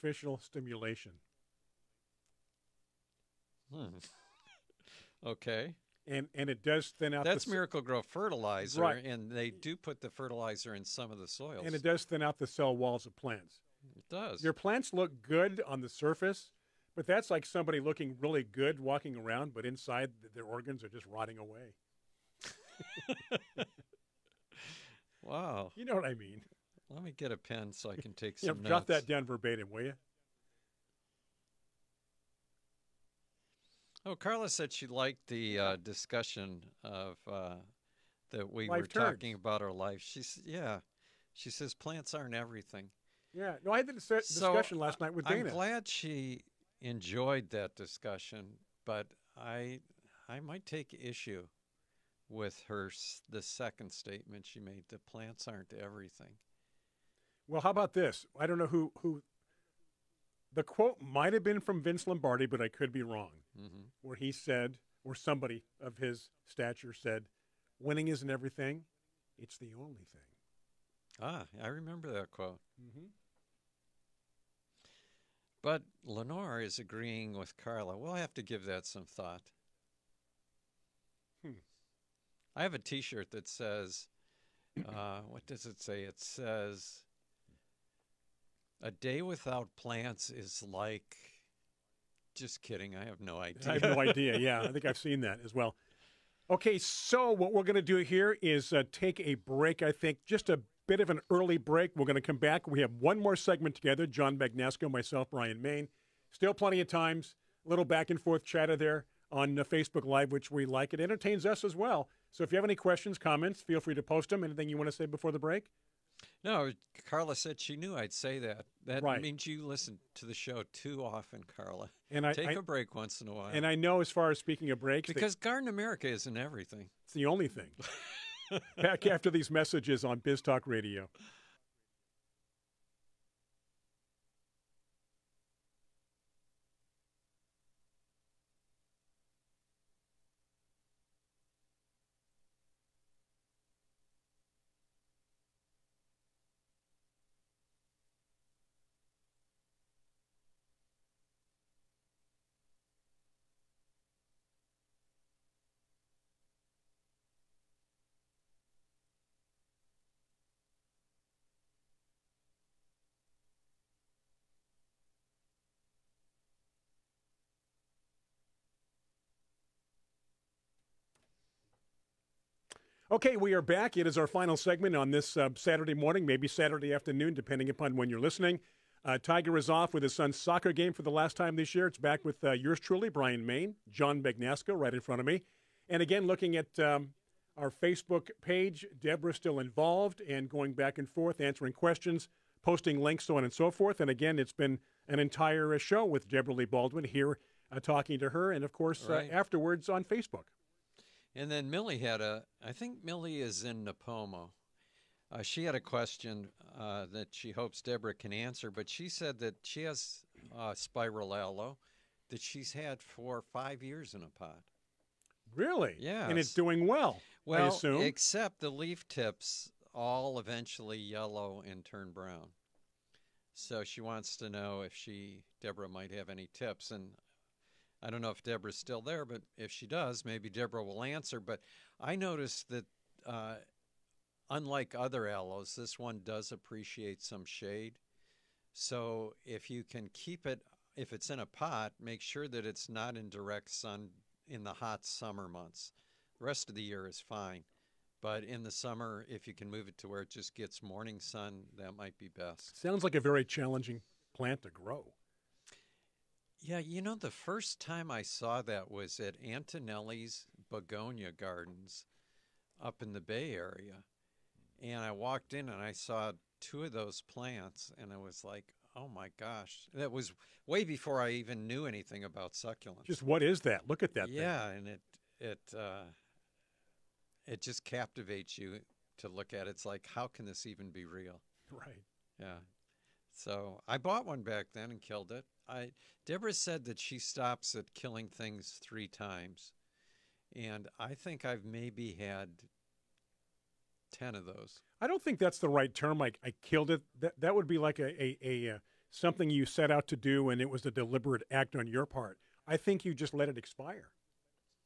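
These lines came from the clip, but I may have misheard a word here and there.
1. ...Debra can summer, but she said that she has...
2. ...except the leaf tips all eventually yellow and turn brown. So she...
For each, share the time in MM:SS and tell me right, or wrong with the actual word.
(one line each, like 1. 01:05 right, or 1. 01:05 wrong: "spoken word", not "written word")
1. 03:27 wrong: "answer", not "summer"
2. 03:37 right.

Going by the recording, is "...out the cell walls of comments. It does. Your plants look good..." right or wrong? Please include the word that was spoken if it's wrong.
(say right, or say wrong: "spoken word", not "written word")
wrong: "plants", not "comments".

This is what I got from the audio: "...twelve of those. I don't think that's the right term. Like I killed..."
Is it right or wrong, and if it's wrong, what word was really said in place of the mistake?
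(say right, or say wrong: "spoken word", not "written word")
wrong: "ten", not "twelve".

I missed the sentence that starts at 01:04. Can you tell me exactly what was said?
where he said, or somebody of his stature said, winning isn't everything, it's the only thing.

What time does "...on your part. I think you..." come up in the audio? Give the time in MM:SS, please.
05:01.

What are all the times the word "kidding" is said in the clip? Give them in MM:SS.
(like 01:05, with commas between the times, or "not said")
01:32.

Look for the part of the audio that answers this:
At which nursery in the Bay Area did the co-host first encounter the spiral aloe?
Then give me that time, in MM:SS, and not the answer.
04:19.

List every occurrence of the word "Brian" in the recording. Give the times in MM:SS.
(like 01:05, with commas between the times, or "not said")
01:45, 03:03.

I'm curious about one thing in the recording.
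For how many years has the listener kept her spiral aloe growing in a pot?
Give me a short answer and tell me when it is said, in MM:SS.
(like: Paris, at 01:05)
5, at 03:33.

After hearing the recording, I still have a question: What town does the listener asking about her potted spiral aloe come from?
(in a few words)
Nipomo.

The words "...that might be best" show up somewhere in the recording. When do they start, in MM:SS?
04:11.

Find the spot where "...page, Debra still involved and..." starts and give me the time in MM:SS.
03:08.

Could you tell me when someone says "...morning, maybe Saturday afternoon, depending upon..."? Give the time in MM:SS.
02:55.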